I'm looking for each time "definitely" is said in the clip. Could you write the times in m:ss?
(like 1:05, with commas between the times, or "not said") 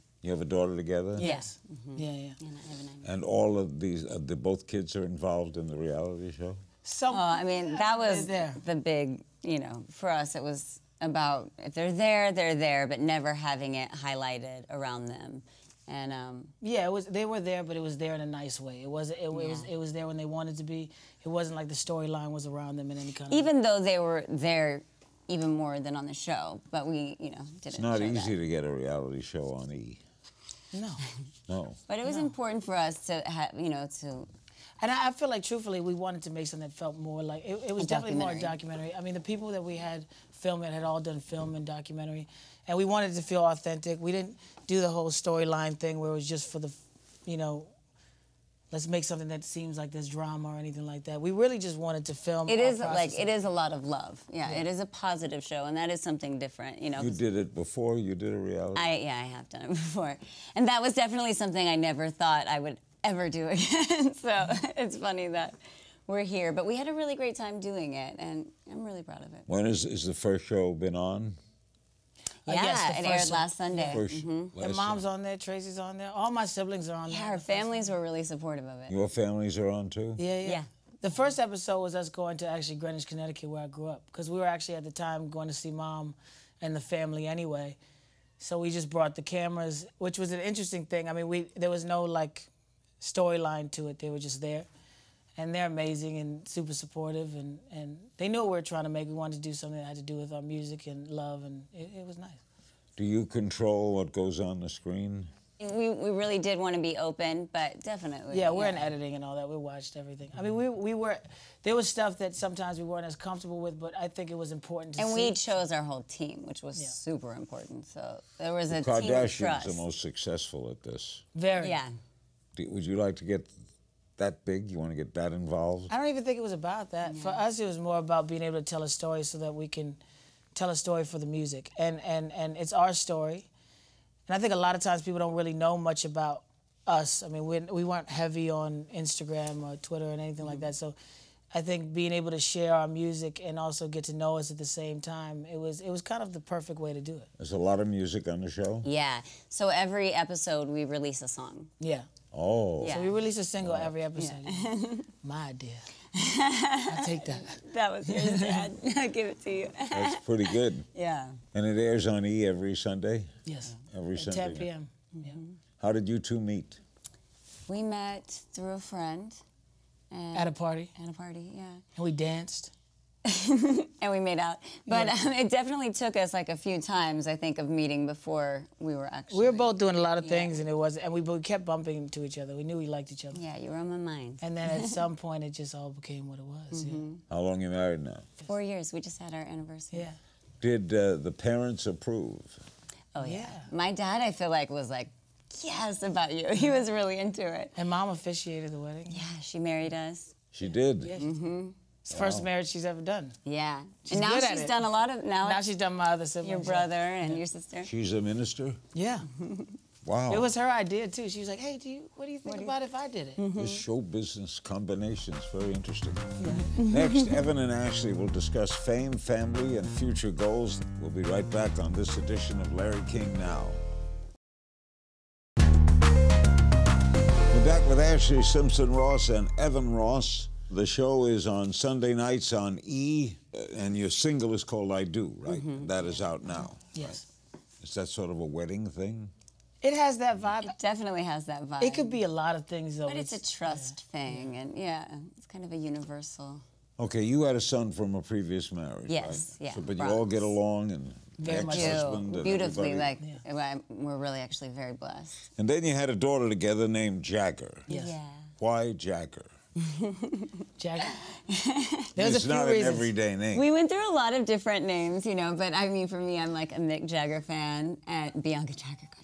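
0:37, 1:00, 1:47, 2:55, 4:00.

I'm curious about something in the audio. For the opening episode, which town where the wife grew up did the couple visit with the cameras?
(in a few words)
Greenwich, Connecticut.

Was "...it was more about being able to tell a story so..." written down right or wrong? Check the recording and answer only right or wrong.
right.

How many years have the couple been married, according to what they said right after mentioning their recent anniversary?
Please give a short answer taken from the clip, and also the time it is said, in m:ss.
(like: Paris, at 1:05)
4, at 3:08.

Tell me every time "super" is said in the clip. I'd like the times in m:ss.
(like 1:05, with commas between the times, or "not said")
1:36, 1:56.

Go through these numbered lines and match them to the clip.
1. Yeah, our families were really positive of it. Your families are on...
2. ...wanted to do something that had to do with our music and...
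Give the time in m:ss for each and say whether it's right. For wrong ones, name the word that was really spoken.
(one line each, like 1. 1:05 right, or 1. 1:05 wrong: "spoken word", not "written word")
1. 1:17 wrong: "supportive", not "positive"
2. 1:39 right.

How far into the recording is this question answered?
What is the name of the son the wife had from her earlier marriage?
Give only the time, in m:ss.
4:09.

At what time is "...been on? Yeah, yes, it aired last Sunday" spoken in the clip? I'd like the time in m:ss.
1:10.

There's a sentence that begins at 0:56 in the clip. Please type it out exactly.
You know, you did it before.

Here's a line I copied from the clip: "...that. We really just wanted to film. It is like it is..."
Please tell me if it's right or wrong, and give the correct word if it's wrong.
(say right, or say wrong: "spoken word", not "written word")
right.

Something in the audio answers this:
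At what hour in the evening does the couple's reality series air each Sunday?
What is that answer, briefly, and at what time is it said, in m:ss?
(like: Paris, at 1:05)
10 p.m., at 2:44.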